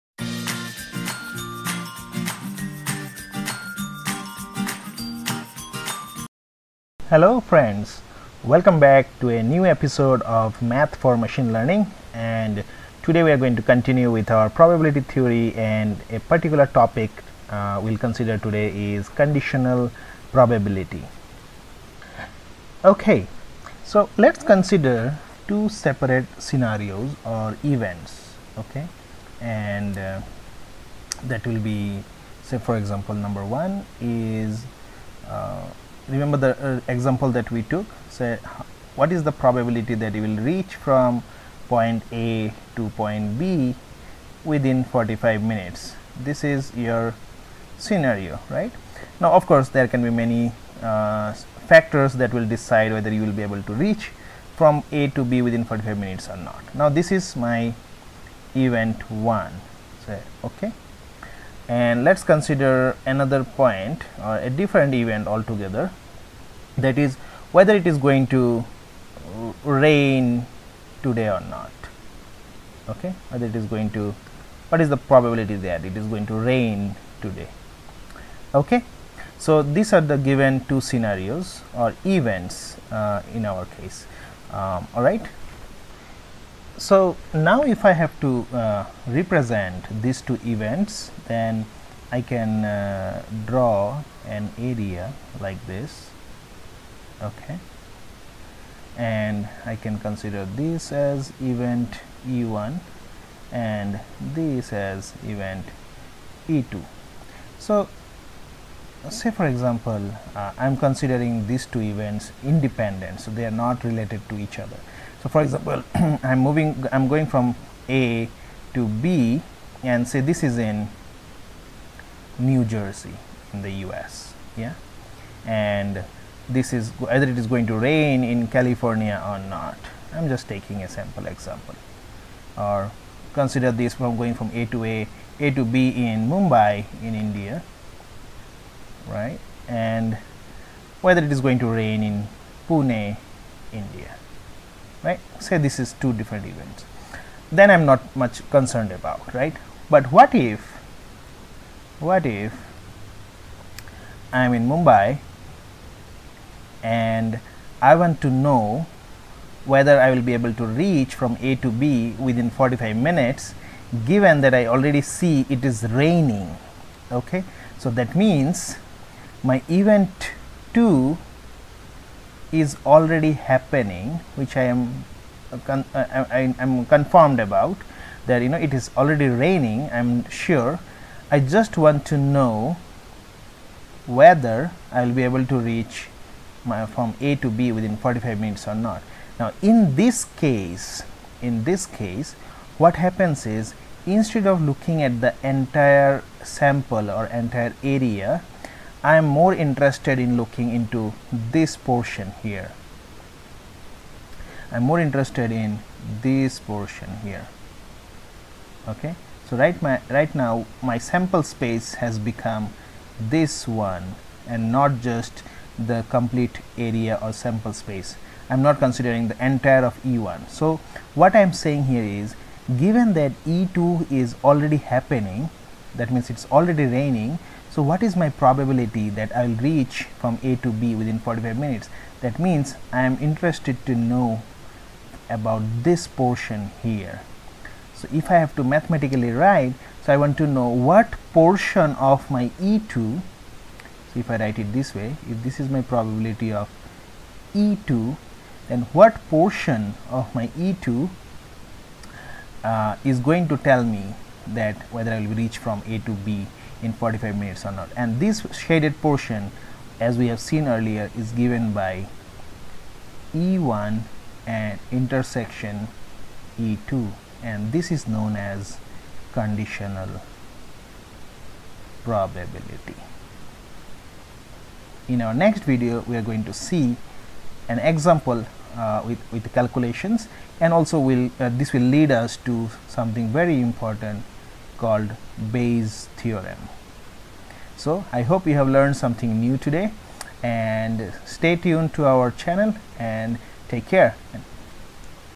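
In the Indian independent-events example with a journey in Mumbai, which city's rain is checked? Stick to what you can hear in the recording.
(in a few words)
Pune.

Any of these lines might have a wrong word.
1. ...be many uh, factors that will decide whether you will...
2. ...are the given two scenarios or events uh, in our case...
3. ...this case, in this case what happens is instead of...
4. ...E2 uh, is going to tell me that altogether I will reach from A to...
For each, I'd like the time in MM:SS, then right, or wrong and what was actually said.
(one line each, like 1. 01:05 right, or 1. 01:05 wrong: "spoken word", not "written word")
1. 00:50 right
2. 01:19 right
3. 03:09 right
4. 04:10 wrong: "whether", not "altogether".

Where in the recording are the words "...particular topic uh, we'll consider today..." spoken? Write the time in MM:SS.
00:16.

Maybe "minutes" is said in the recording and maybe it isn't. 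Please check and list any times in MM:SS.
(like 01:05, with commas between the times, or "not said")
00:45, 00:55, 02:42, 03:08, 03:51, 04:17.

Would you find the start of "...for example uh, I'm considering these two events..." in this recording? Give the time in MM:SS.
01:49.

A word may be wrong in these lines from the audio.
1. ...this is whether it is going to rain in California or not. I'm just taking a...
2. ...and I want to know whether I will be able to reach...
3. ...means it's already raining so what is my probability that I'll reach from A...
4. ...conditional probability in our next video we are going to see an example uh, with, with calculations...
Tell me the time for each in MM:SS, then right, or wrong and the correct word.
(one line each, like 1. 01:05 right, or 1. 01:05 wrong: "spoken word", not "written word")
1. 02:06 right
2. 02:36 right
3. 03:46 right
4. 04:29 right.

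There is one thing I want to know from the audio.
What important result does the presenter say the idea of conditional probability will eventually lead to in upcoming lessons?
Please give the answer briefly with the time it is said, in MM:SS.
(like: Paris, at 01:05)
Bayes theorem, at 04:45.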